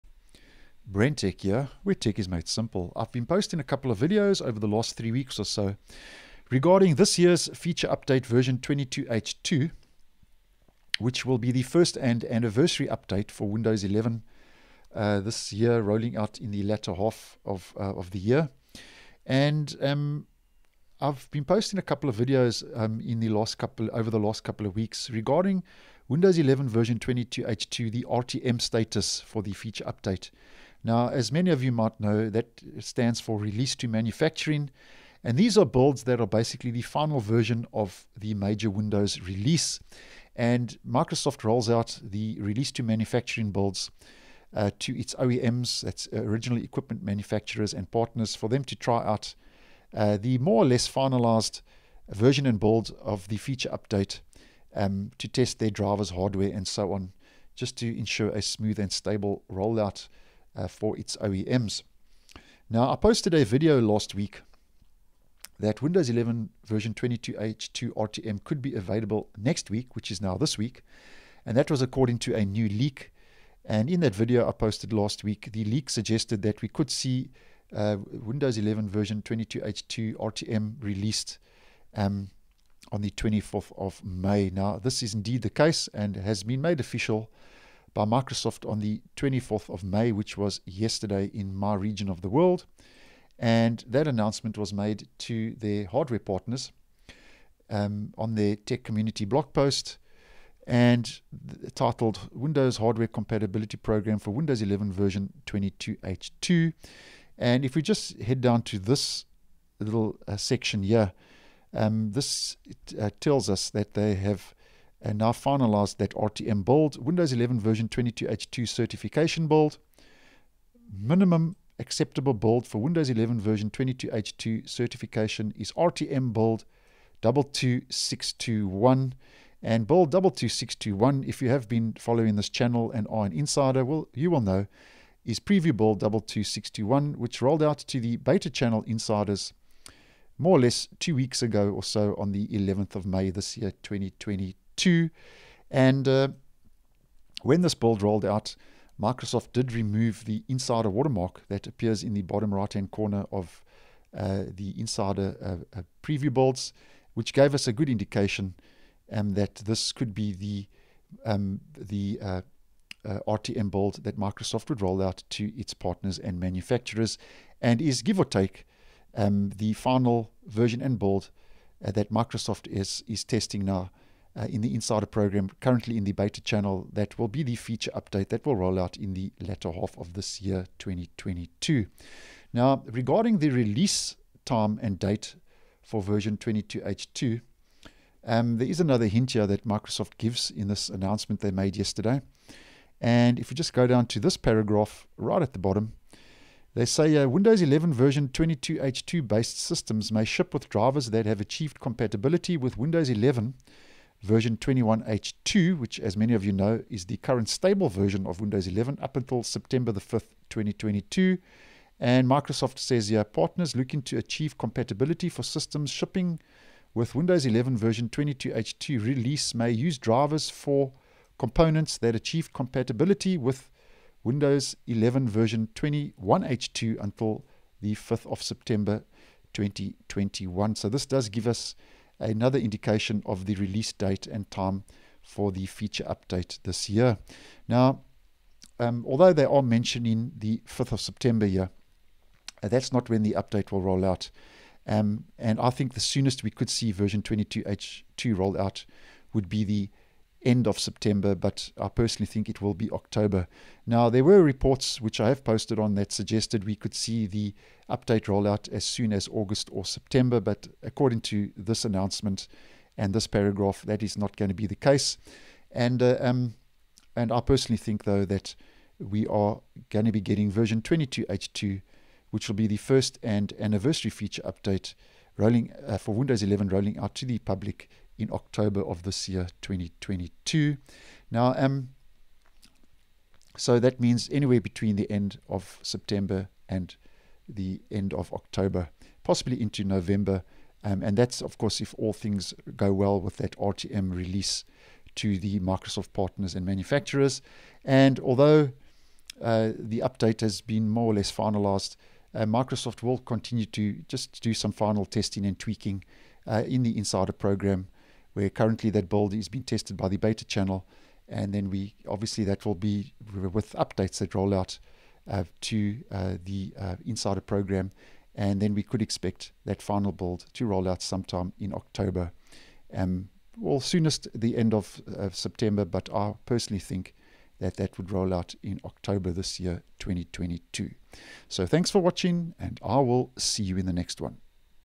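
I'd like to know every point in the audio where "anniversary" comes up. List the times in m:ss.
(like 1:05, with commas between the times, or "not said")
0:12, 4:33.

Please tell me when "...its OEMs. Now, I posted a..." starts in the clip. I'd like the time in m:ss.
1:00.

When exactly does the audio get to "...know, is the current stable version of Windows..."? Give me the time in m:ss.
3:26.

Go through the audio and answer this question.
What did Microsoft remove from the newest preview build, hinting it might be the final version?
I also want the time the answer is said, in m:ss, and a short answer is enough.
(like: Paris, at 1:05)
insider watermark, at 2:30.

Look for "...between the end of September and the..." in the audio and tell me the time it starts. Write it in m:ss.
4:44.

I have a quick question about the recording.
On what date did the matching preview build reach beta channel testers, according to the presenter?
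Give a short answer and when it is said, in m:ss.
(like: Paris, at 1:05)
11th of May, at 2:22.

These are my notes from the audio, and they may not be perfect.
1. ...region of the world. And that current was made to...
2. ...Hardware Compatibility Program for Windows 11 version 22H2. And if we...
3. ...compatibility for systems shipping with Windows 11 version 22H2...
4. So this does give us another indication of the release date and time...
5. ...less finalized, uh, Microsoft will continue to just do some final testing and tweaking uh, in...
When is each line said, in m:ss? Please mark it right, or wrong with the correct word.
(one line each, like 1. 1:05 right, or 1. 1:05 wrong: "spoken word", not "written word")
1. 1:31 wrong: "announcement", not "current"
2. 1:42 right
3. 3:34 right
4. 3:50 right
5. 5:01 right.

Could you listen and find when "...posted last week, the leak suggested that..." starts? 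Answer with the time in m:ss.
1:14.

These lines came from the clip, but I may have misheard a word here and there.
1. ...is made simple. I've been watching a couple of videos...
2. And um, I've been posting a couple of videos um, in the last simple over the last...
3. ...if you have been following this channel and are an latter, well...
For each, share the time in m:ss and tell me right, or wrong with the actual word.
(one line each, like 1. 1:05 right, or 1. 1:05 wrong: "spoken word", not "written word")
1. 0:02 wrong: "posting", not "watching"
2. 0:19 wrong: "couple", not "simple"
3. 2:11 wrong: "insider", not "latter".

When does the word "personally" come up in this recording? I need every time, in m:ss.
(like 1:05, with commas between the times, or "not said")
4:11, 4:27, 5:26.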